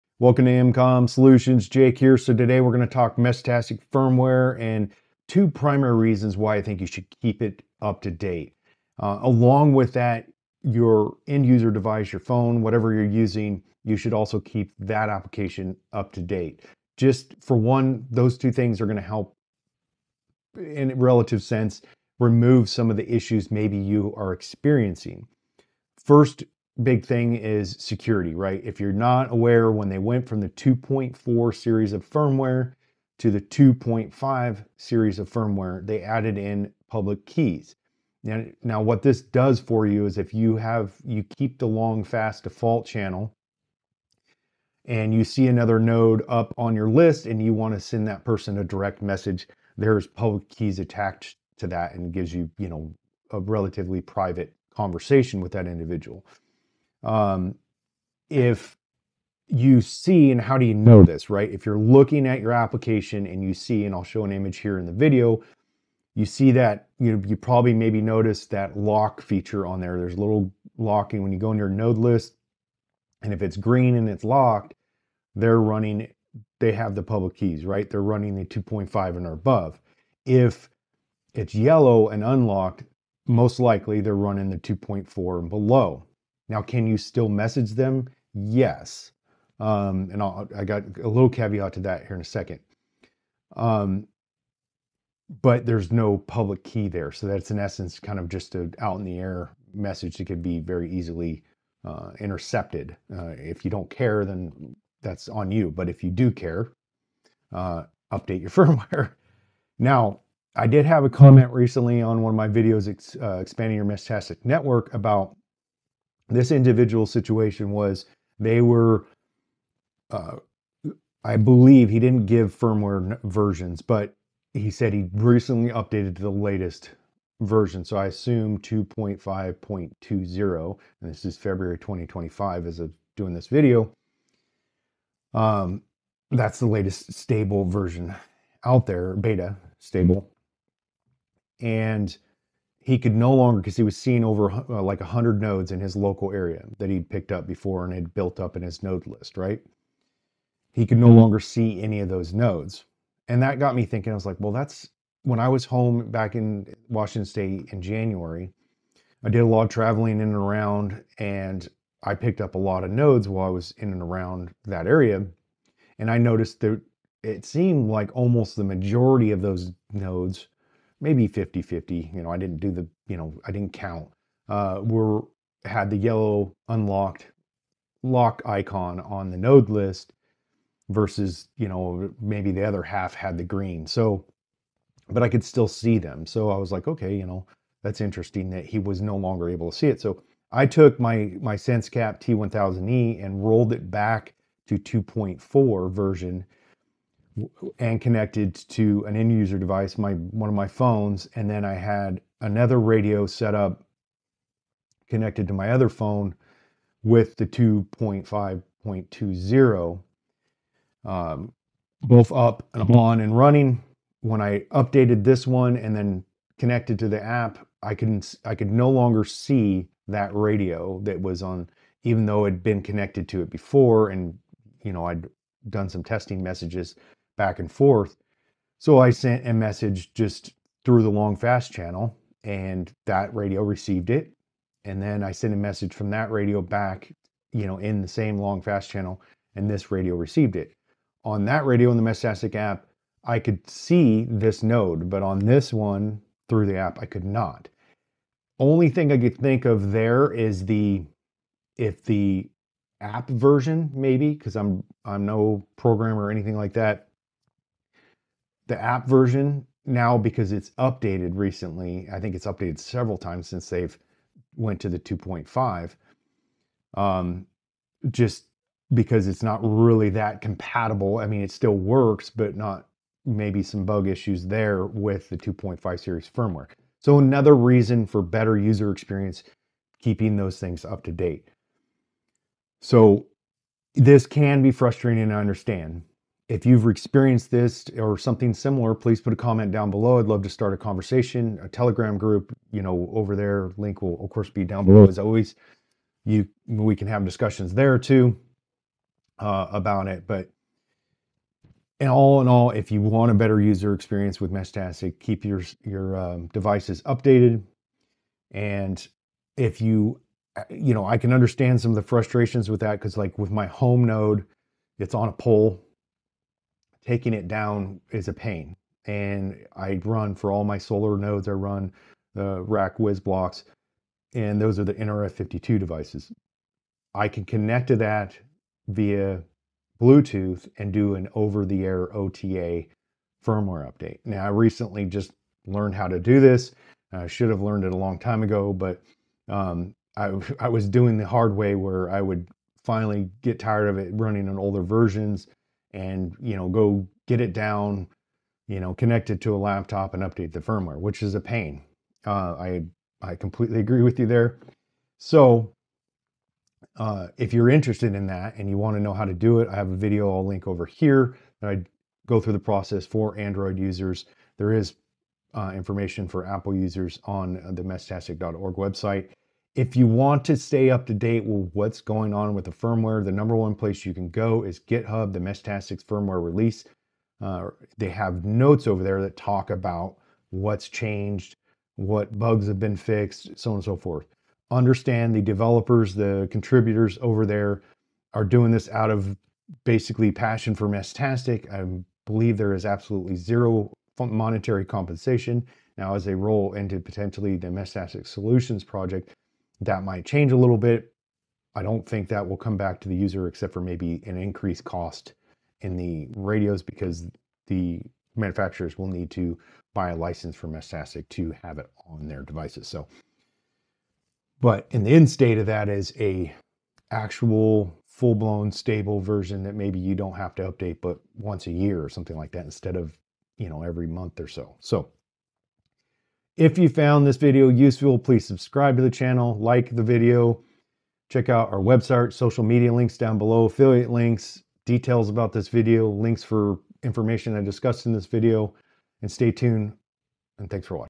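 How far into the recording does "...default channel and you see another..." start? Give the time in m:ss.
0:42.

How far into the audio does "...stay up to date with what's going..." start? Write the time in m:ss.
6:10.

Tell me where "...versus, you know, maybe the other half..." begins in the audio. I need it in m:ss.
3:00.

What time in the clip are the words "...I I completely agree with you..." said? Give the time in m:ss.
5:52.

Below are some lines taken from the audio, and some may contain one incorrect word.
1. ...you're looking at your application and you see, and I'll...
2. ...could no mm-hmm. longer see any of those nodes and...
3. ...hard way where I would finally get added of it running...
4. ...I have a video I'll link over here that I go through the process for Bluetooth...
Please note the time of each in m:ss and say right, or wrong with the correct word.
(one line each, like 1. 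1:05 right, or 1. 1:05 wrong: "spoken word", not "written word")
1. 1:01 right
2. 2:30 right
3. 5:41 wrong: "tired", not "added"
4. 5:59 wrong: "Android", not "Bluetooth".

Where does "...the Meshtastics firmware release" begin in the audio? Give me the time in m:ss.
6:15.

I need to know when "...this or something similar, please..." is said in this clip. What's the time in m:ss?
4:47.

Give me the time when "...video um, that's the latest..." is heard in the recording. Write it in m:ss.
2:13.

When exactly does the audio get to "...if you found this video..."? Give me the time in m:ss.
7:06.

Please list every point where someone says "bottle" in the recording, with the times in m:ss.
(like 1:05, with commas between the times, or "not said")
not said.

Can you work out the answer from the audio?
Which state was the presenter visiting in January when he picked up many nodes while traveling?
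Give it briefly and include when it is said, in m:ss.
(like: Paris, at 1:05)
Washington, at 2:36.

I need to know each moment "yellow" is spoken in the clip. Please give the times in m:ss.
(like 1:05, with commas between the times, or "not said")
1:21, 2:55.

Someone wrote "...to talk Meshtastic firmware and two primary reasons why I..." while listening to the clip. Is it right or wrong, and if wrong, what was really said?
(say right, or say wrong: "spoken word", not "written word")
right.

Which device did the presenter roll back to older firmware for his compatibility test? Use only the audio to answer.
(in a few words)
SenseCap T1000E.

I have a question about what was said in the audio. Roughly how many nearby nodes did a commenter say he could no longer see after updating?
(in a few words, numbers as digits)
100.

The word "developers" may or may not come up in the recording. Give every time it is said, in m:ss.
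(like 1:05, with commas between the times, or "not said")
6:25.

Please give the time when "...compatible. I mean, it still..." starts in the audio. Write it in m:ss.
4:30.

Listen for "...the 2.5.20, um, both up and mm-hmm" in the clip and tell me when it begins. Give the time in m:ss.
3:27.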